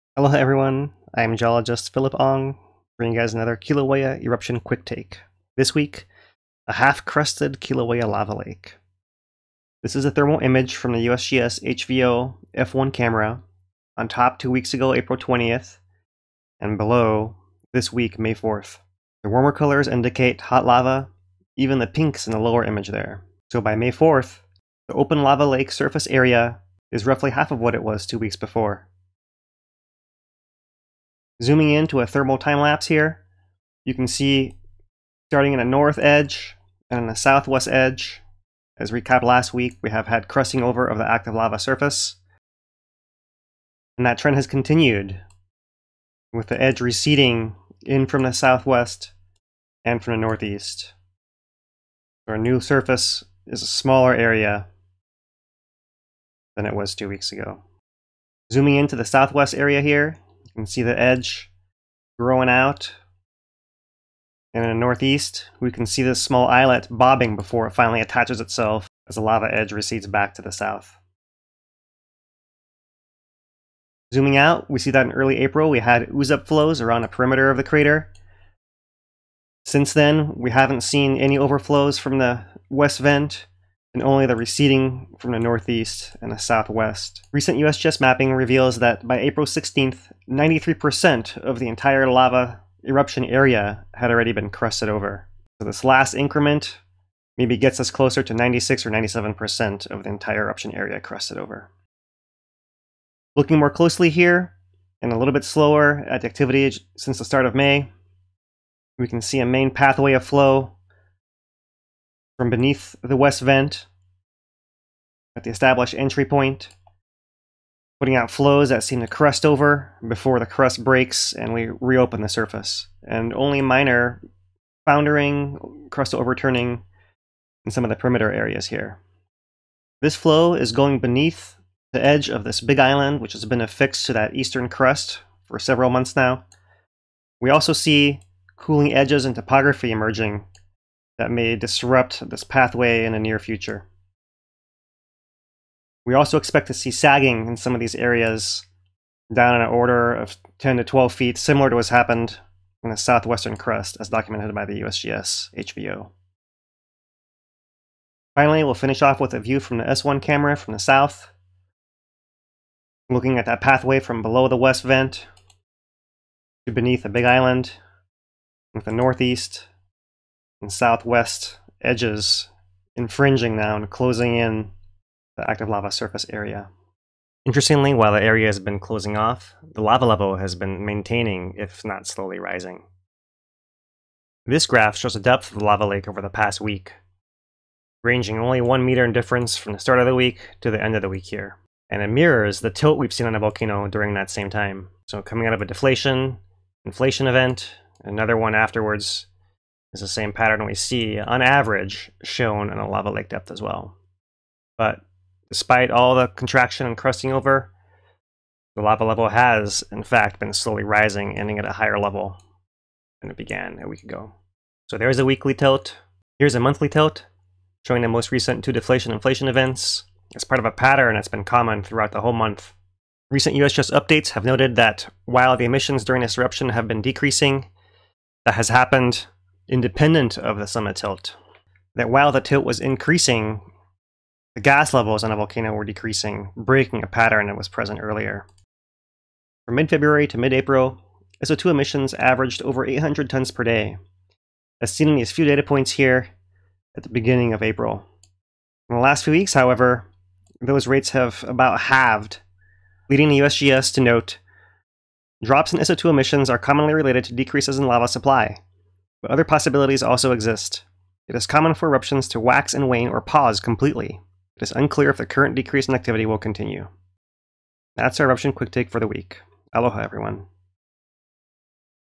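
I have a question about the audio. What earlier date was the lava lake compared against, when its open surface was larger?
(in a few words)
April 20th.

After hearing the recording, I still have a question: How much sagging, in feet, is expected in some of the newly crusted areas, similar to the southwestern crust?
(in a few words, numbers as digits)
10 to 12 feet.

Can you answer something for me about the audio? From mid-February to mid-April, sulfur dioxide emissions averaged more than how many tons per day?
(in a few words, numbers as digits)
800.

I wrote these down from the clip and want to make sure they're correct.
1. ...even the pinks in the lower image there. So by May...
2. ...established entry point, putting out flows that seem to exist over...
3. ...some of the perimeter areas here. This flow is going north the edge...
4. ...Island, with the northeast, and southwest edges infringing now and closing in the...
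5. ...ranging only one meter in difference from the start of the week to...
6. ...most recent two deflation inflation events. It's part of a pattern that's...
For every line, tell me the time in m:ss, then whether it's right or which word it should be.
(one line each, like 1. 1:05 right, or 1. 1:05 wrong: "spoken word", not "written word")
1. 0:21 right
2. 1:55 wrong: "crest", not "exist"
3. 2:07 wrong: "beneath", not "north"
4. 2:47 right
5. 3:08 right
6. 3:38 right.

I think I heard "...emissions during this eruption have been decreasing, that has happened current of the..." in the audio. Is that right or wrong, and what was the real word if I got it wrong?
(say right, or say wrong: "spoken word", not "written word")
wrong: "independent", not "current".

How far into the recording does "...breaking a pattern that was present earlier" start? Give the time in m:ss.
3:56.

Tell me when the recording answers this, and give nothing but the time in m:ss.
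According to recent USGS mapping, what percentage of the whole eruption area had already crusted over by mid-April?
1:30.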